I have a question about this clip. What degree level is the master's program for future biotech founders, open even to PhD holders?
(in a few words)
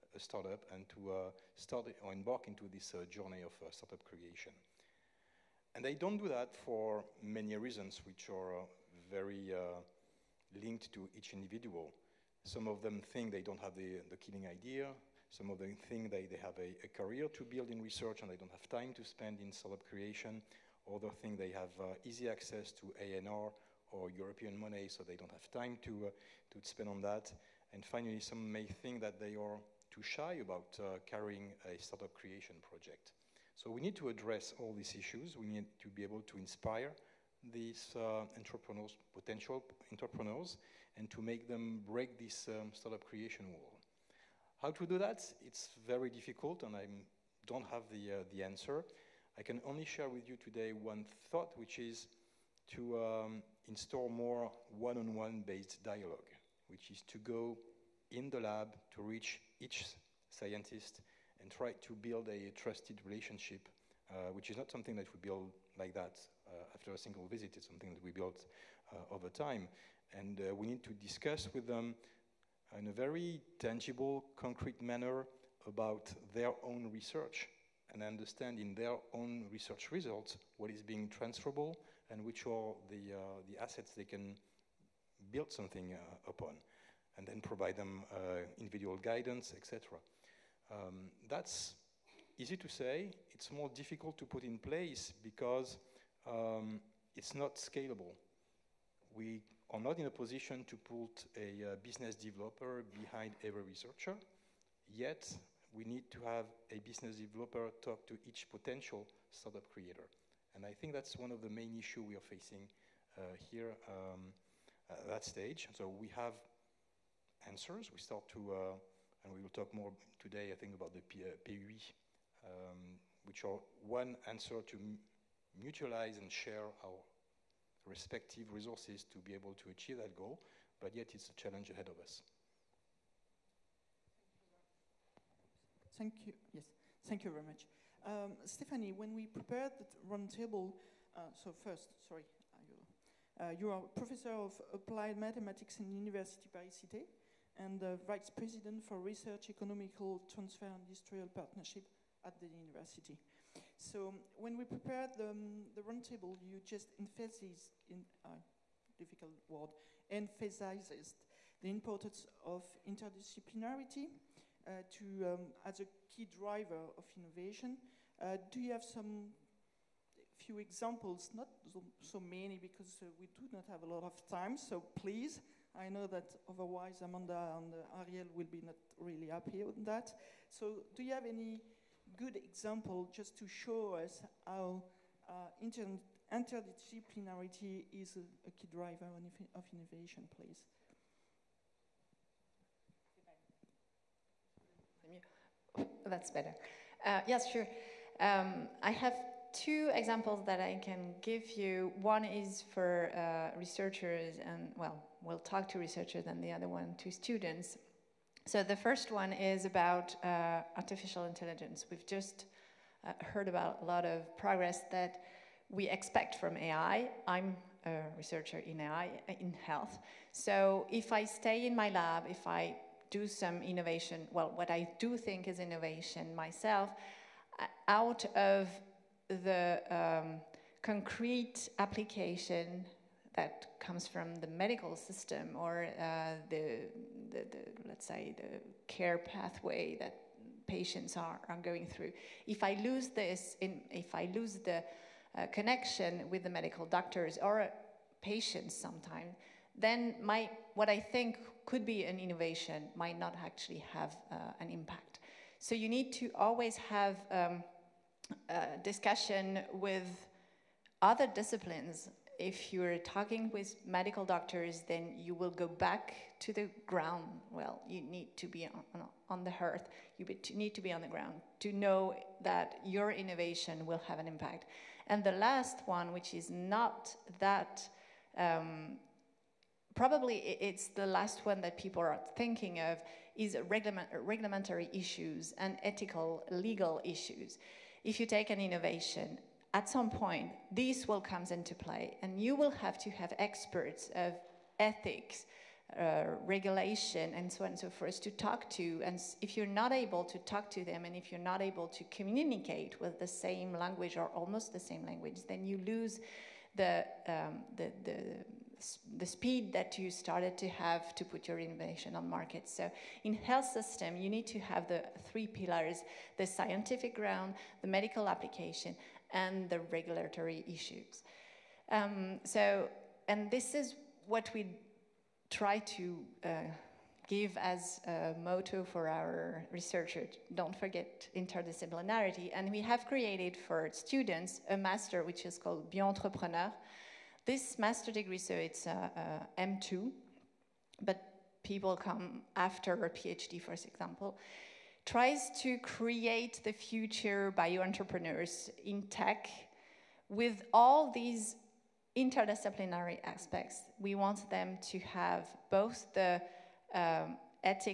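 M2.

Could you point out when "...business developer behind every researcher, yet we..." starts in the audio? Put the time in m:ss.
1:41.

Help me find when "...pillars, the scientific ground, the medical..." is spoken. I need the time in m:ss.
5:15.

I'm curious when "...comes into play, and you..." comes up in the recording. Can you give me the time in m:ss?
4:51.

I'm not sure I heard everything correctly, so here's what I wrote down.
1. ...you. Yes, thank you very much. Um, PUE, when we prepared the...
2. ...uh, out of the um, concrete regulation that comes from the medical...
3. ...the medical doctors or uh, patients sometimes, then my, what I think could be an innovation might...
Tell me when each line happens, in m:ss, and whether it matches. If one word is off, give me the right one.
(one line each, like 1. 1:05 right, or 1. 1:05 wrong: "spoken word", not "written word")
1. 2:16 wrong: "Stephanie", not "PUE"
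2. 3:47 wrong: "application", not "regulation"
3. 4:06 right.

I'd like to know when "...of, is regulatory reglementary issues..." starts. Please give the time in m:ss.
4:42.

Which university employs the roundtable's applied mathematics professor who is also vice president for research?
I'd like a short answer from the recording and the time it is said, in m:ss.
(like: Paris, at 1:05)
University Paris-Cité, at 2:25.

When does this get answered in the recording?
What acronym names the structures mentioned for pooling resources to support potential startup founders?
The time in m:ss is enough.
2:01.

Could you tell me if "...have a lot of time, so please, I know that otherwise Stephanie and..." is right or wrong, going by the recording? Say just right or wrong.
wrong.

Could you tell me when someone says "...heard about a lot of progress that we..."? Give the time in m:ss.
3:33.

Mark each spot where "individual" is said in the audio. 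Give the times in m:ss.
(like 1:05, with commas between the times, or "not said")
0:11, 1:28.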